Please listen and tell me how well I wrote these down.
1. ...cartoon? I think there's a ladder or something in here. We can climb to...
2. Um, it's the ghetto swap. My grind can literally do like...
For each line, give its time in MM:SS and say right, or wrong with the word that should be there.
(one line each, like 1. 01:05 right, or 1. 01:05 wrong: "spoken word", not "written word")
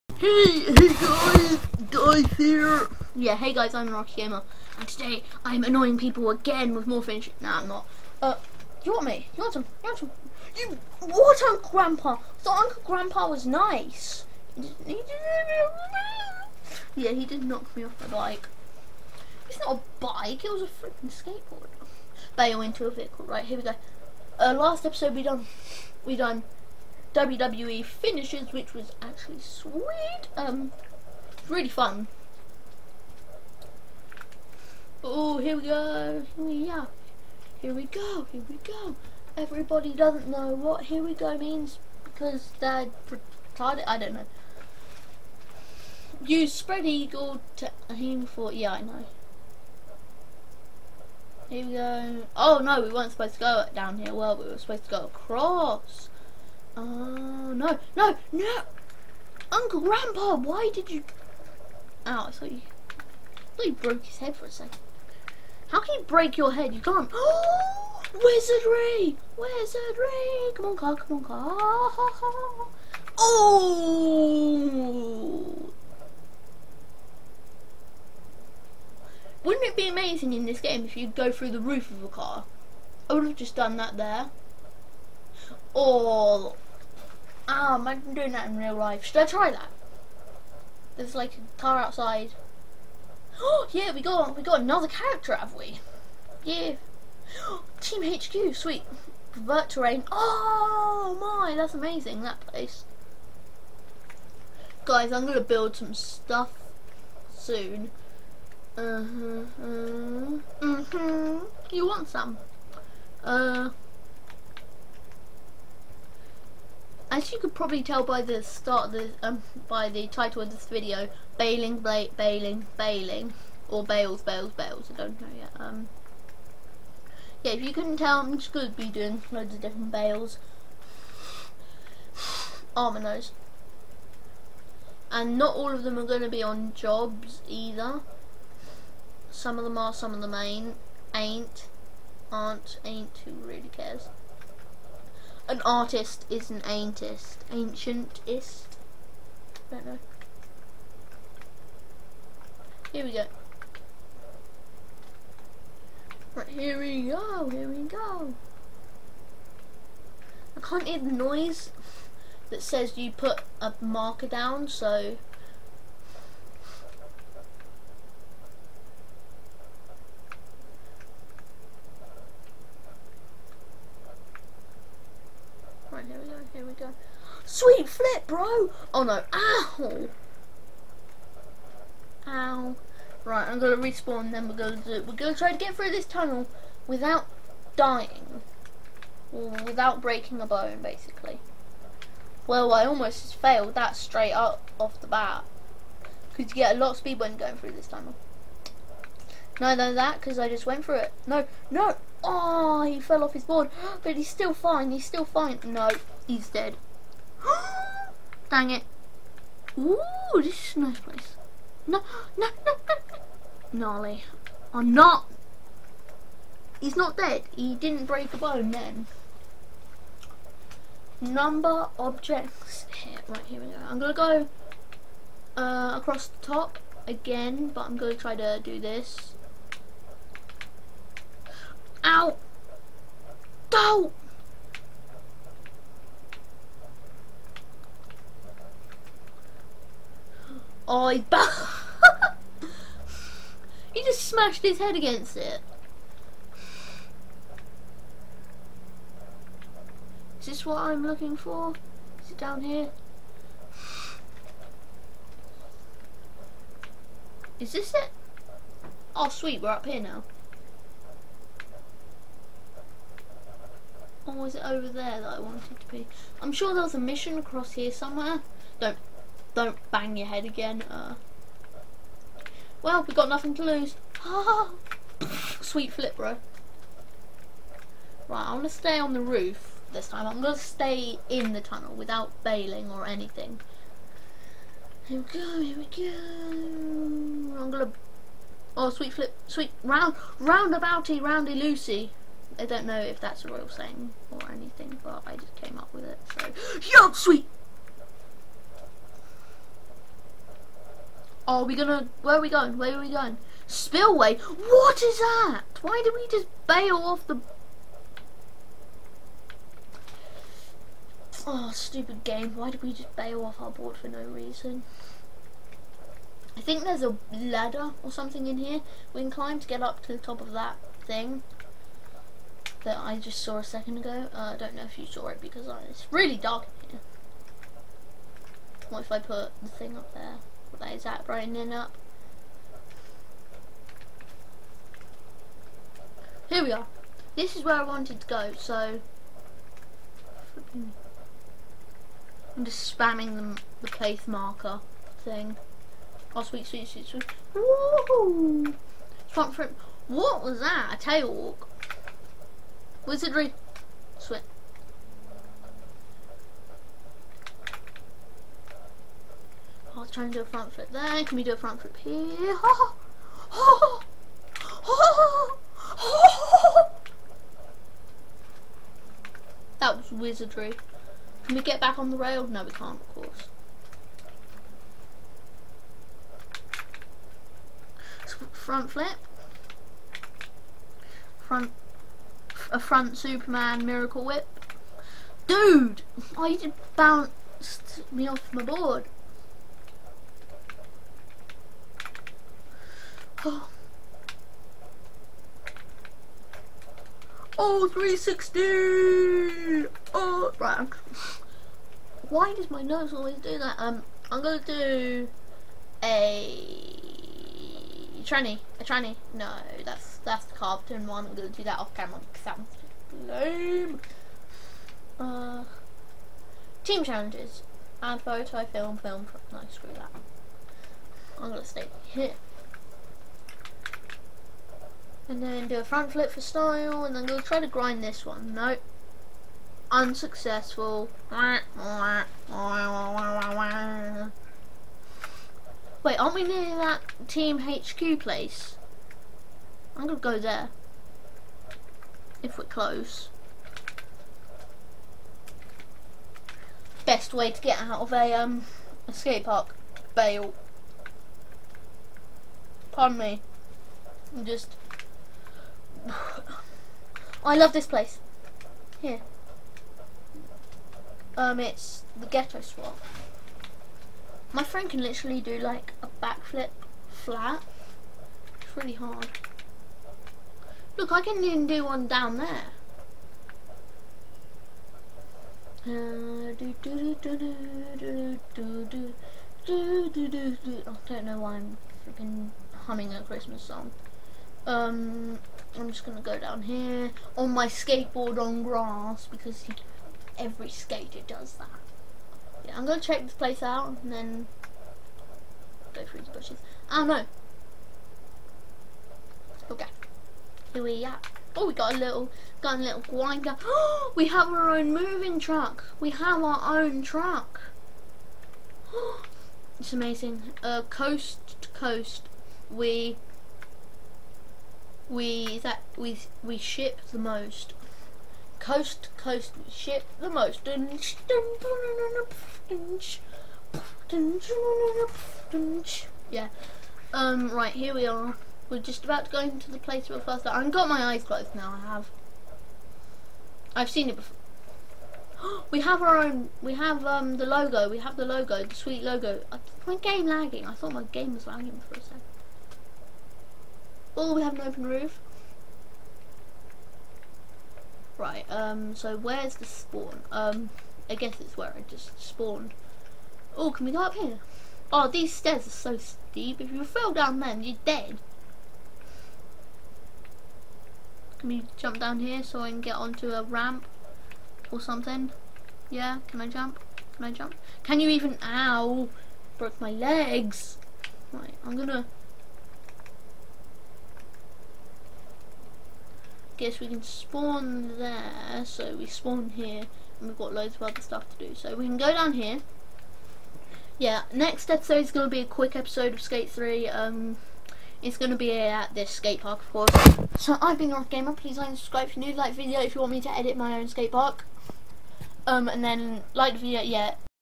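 1. 05:14 wrong: "reason", not "cartoon"
2. 07:41 wrong: "friend", not "grind".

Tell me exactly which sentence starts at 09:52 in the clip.
Like video if you want me to edit my own skate park.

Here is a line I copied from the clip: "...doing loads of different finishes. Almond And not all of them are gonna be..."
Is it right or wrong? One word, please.
wrong.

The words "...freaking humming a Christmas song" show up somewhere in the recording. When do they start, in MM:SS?
08:02.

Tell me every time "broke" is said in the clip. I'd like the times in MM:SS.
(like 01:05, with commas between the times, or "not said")
01:03, 09:29.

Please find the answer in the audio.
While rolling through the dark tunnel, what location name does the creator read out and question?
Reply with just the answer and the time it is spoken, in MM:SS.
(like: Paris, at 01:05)
Spillway, at 05:03.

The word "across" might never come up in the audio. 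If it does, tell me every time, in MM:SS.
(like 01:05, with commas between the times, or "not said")
00:55, 03:45, 04:27.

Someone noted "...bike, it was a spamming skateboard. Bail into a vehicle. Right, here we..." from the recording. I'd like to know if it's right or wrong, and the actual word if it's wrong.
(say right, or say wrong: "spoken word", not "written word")
wrong: "freaking", not "spamming".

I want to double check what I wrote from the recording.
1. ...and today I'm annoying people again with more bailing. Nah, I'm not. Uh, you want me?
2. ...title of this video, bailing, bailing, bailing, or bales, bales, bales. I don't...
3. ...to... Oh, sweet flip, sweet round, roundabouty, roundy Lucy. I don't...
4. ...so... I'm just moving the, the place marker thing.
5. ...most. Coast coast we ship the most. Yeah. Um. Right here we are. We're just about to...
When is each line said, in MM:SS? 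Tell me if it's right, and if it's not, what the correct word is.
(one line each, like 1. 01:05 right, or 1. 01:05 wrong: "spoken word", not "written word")
1. 00:04 wrong: "finishing", not "bailing"
2. 02:00 right
3. 04:47 right
4. 05:38 wrong: "spamming", not "moving"
5. 08:37 right.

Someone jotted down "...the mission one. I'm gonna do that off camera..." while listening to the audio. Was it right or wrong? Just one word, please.
wrong.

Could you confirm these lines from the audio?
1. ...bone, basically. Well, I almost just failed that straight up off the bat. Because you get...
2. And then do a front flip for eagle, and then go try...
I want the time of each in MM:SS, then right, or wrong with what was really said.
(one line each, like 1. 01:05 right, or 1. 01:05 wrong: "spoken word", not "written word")
1. 03:10 right
2. 07:05 wrong: "style", not "eagle".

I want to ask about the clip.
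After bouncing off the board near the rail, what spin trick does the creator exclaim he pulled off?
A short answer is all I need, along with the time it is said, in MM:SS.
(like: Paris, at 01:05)
360, at 06:37.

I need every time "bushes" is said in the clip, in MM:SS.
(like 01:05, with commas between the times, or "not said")
08:16.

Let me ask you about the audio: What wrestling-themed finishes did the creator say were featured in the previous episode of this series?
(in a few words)
WWE finishes.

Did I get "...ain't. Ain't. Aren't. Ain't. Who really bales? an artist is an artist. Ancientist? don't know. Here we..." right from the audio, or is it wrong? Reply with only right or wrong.
wrong.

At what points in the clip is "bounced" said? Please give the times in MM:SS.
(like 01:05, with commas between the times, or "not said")
06:26.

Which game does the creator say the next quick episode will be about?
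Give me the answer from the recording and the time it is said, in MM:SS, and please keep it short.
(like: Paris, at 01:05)
Skate 3, at 09:46.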